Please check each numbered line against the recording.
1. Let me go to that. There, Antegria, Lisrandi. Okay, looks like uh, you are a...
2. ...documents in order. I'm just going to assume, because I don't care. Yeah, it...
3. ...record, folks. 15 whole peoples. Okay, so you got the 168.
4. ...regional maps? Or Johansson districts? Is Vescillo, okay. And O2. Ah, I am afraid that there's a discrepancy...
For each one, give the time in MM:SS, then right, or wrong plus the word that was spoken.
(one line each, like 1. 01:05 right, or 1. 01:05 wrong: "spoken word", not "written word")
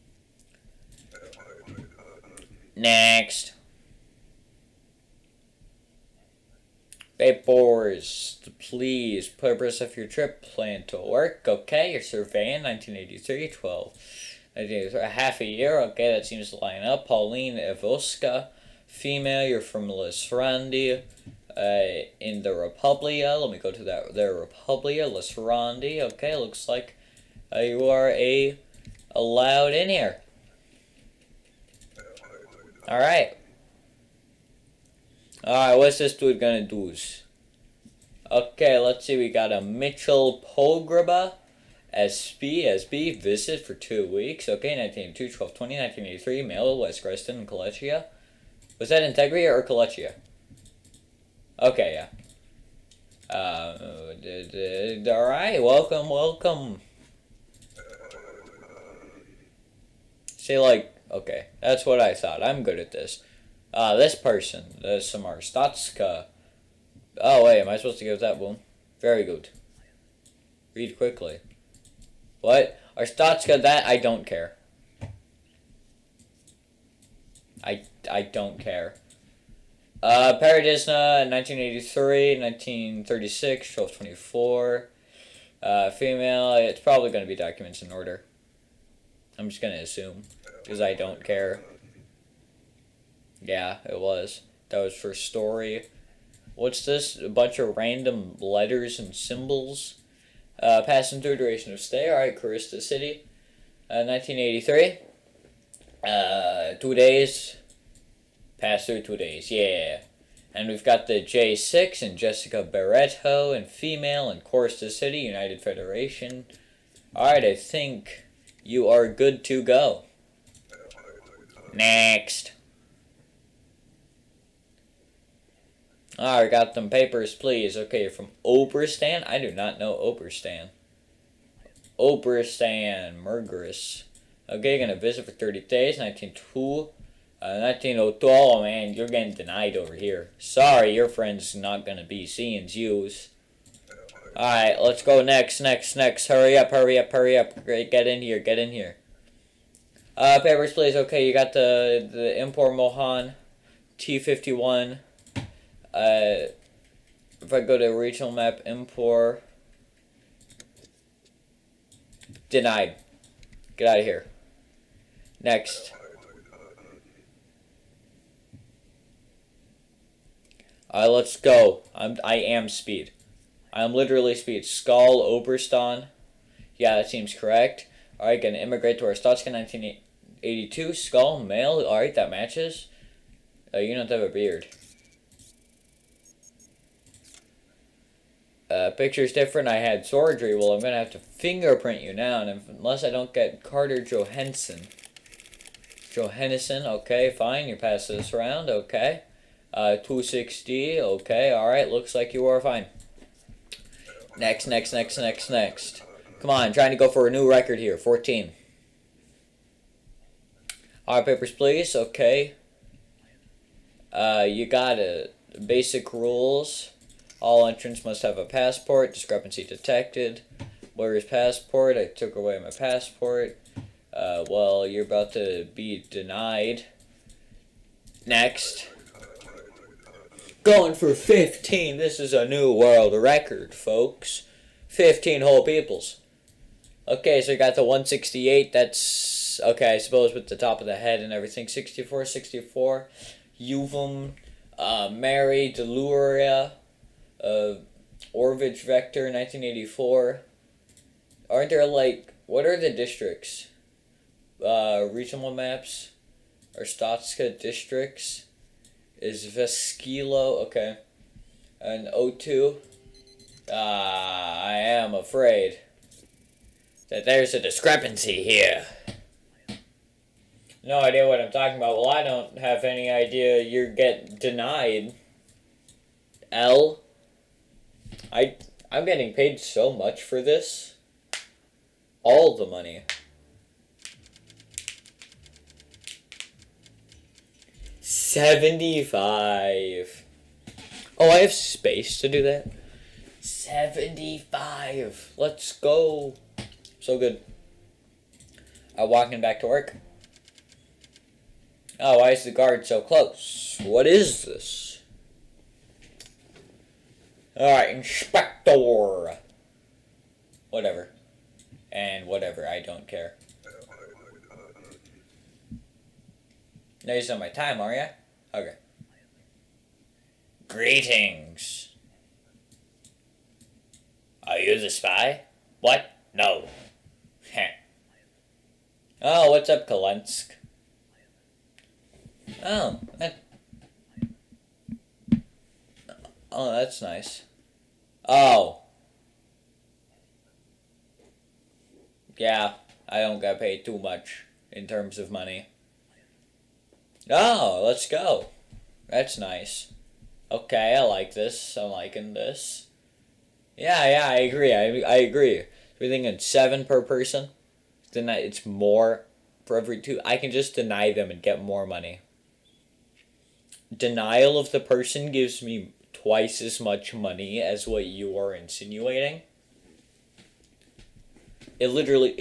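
1. 00:23 wrong: "Republia", not "Antegria"
2. 01:27 right
3. 03:53 right
4. 04:15 wrong: "Stotska", not "Johansson".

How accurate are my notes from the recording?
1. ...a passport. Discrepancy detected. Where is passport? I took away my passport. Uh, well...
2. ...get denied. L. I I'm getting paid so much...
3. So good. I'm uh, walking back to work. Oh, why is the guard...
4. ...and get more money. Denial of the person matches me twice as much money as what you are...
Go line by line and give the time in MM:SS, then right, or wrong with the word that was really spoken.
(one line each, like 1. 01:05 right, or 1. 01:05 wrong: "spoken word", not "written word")
1. 03:38 right
2. 04:33 right
3. 04:57 right
4. 06:01 wrong: "gives", not "matches".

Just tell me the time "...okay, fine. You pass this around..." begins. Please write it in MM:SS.
03:16.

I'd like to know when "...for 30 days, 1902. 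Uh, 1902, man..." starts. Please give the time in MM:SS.
02:15.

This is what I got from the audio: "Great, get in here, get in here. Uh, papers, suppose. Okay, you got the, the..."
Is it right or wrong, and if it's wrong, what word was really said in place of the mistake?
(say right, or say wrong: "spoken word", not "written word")
wrong: "please", not "suppose".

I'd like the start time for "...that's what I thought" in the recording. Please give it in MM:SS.
01:01.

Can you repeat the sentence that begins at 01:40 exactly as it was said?
Uh, passenger duration of stay, all right, Korista City, uh, 1983.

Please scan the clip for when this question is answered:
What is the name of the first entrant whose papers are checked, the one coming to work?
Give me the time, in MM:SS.
00:17.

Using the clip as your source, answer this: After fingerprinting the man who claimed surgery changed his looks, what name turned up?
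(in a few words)
Carter Johansson.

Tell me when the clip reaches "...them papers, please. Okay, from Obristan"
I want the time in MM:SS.
02:06.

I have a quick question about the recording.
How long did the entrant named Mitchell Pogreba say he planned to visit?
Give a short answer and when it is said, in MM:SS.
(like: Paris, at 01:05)
two weeks, at 00:43.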